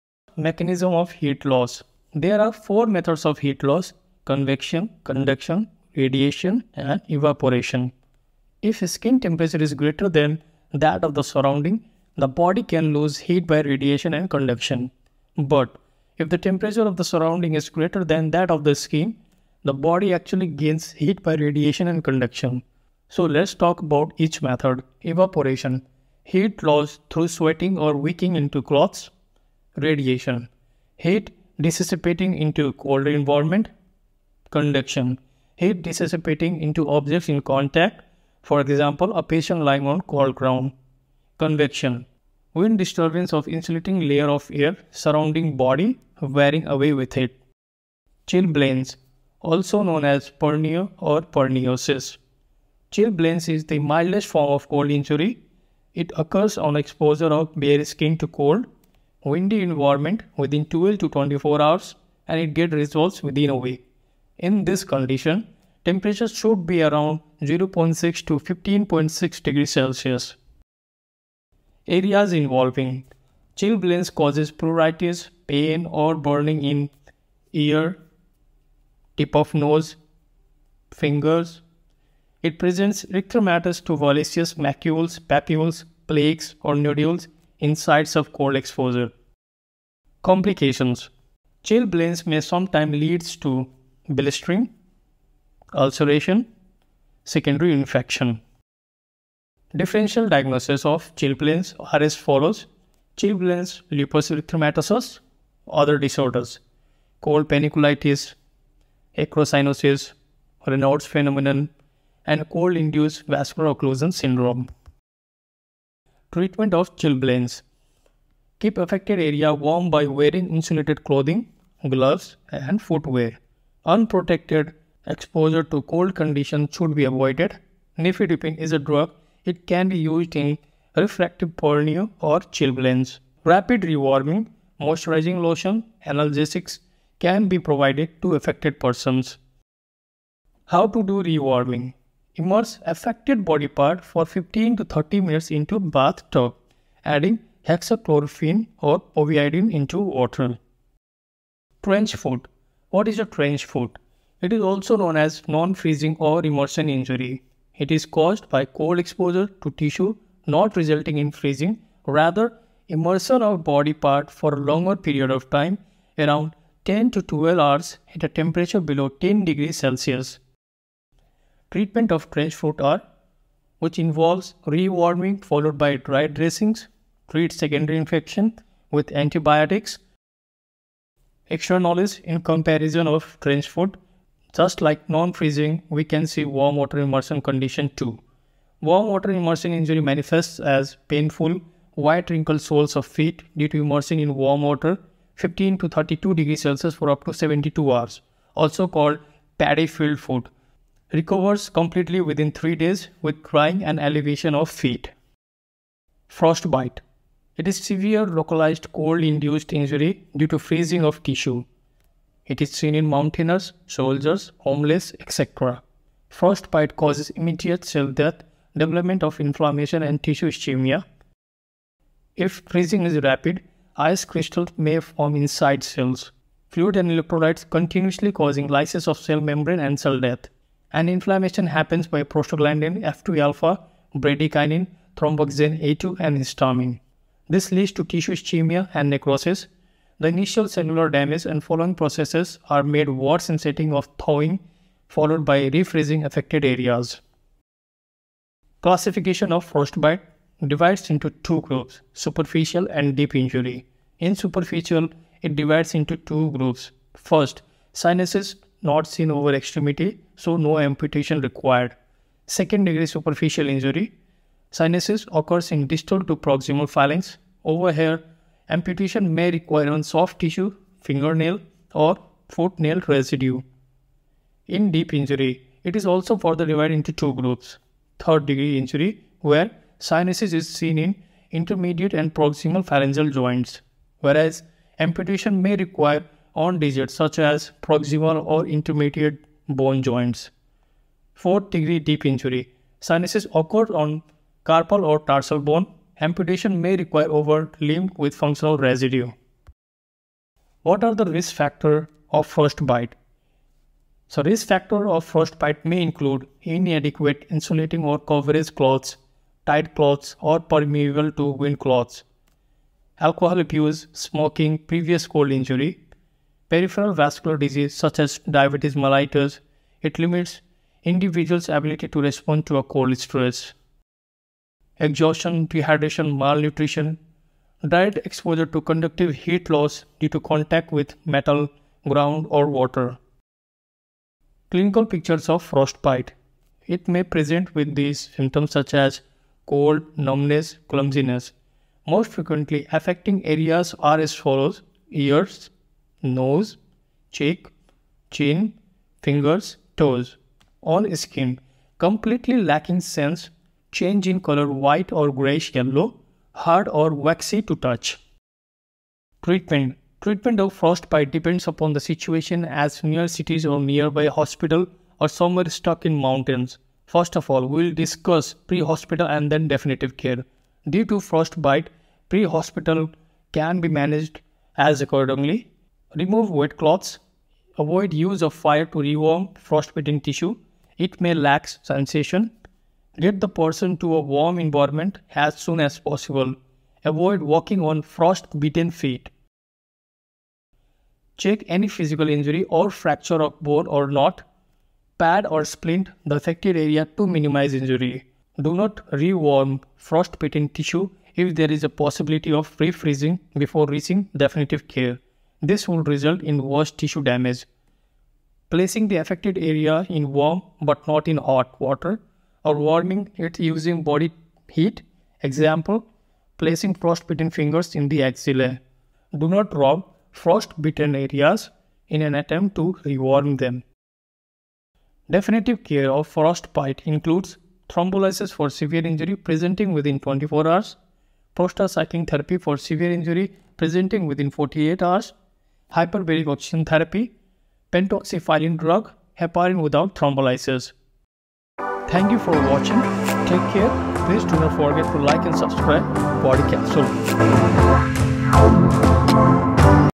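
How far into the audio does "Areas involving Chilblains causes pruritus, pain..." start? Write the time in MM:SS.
01:11.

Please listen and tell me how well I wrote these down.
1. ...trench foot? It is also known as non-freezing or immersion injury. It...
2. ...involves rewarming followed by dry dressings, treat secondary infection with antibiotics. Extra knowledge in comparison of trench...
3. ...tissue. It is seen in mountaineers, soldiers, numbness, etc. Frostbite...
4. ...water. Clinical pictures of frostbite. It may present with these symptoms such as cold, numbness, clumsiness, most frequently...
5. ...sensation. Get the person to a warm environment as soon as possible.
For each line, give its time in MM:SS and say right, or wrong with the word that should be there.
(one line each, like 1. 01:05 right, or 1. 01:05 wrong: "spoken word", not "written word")
1. 02:33 right
2. 02:53 right
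3. 03:31 wrong: "homeless", not "numbness"
4. 05:32 right
5. 06:21 right.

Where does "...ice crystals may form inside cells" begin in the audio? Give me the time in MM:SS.
03:43.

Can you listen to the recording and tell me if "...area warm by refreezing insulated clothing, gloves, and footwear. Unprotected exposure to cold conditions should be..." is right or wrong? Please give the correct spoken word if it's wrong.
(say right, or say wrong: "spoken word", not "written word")
wrong: "wearing", not "refreezing".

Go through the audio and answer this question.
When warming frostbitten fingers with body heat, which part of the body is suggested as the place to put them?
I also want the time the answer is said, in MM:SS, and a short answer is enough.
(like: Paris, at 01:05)
Axilla, at 06:58.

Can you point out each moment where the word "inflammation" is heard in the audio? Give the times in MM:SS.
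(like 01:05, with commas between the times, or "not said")
03:39, 03:51.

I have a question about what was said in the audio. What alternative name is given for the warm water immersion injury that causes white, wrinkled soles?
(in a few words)
Paddy field foot.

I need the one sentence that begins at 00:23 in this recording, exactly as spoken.
So let's talk about each method.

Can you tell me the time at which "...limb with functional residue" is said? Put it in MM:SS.
04:57.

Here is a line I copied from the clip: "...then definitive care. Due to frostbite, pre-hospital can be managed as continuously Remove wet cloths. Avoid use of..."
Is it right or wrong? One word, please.
wrong.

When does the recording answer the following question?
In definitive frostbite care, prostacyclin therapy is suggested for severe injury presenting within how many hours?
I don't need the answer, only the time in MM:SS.
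07:14.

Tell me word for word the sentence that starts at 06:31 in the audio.
Check any physical injury or fracture of bone or not.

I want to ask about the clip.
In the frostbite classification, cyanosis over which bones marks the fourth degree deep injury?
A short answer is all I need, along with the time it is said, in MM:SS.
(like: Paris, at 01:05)
Carpal or tarsal bone, at 04:54.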